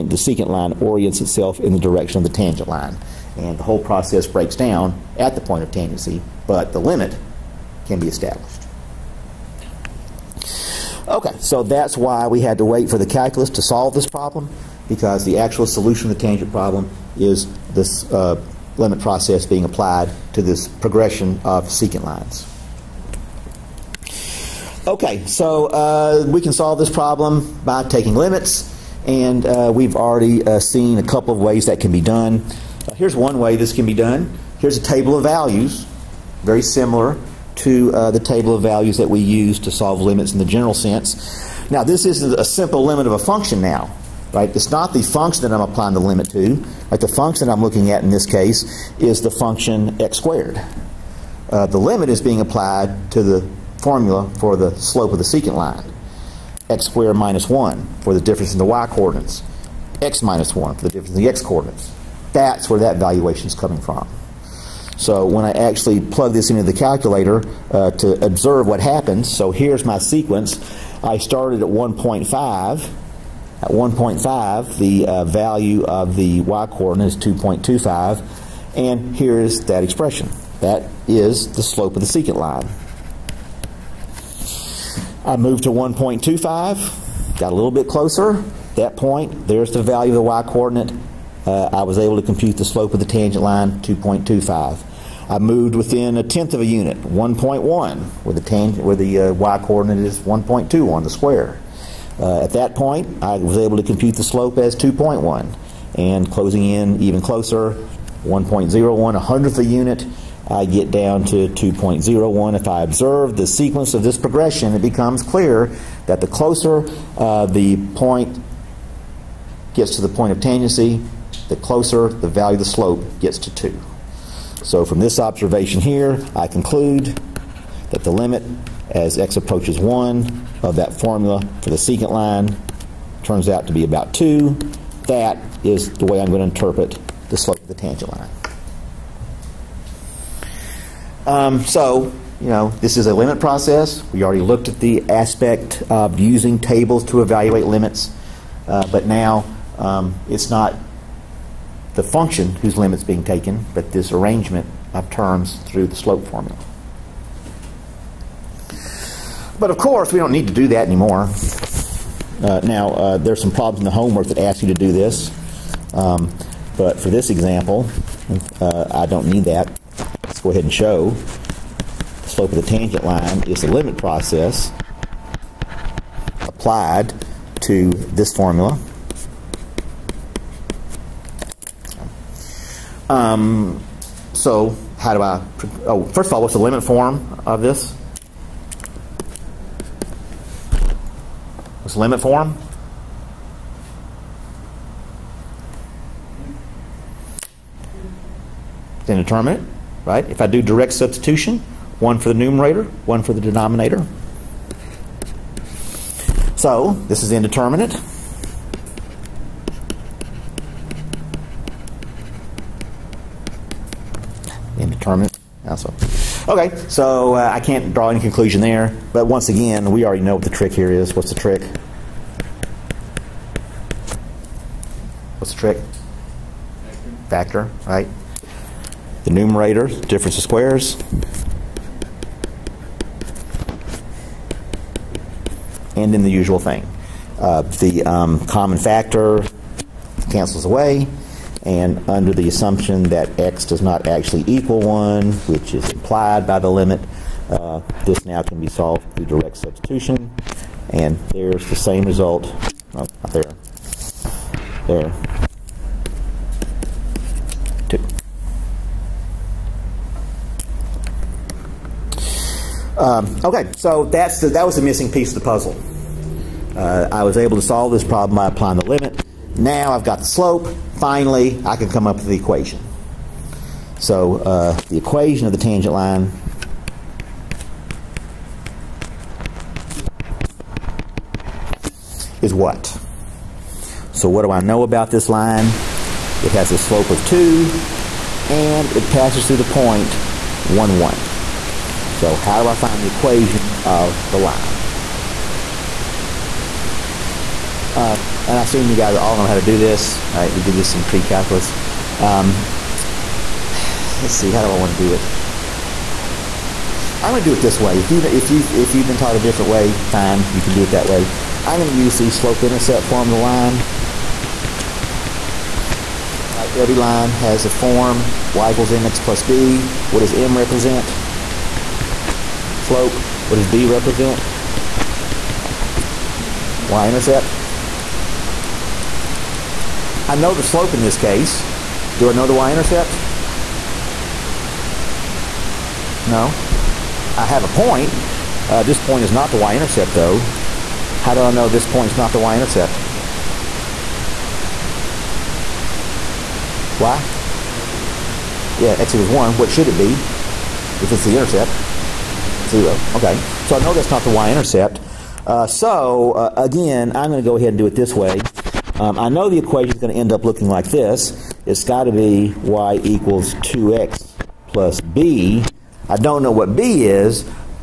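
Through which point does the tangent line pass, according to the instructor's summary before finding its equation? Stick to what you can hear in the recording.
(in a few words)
(1, 1).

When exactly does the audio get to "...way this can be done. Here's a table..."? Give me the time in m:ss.
0:33.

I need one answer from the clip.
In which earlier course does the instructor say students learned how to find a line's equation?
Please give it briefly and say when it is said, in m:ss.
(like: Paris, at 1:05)
pre-calculus, at 5:01.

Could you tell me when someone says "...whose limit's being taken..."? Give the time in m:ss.
2:32.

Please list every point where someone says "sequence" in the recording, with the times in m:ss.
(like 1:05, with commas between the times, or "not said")
1:09, 1:53.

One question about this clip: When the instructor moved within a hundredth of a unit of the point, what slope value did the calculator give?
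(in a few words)
2.01.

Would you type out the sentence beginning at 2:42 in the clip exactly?
Uh, now, uh, there's some problems in the homework that ask you to do this.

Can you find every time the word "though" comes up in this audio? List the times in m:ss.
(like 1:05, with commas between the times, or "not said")
5:40.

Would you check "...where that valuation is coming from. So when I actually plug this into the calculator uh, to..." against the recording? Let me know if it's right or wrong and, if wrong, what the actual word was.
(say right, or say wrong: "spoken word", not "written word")
right.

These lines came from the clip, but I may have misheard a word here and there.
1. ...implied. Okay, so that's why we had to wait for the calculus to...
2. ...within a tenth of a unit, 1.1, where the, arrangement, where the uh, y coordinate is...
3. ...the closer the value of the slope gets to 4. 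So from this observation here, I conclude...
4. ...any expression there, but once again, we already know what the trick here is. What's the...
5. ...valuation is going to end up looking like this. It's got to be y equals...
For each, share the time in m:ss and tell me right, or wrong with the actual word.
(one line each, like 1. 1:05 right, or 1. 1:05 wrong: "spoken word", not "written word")
1. 0:08 wrong: "established", not "implied"
2. 1:35 wrong: "tangent", not "arrangement"
3. 2:01 wrong: "2", not "4"
4. 3:38 wrong: "conclusion", not "expression"
5. 5:59 wrong: "equation", not "valuation".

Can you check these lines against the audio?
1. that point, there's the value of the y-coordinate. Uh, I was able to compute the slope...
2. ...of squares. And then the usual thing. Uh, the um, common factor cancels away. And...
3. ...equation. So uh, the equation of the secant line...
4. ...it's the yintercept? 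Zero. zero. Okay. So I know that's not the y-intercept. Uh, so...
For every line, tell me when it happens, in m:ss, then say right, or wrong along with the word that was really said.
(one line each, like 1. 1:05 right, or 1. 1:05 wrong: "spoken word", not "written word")
1. 1:28 right
2. 3:50 right
3. 4:32 wrong: "tangent", not "secant"
4. 5:51 wrong: "intercept", not "yintercept".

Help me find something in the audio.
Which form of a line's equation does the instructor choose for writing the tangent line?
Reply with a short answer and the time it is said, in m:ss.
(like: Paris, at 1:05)
slope-intercept form, at 5:12.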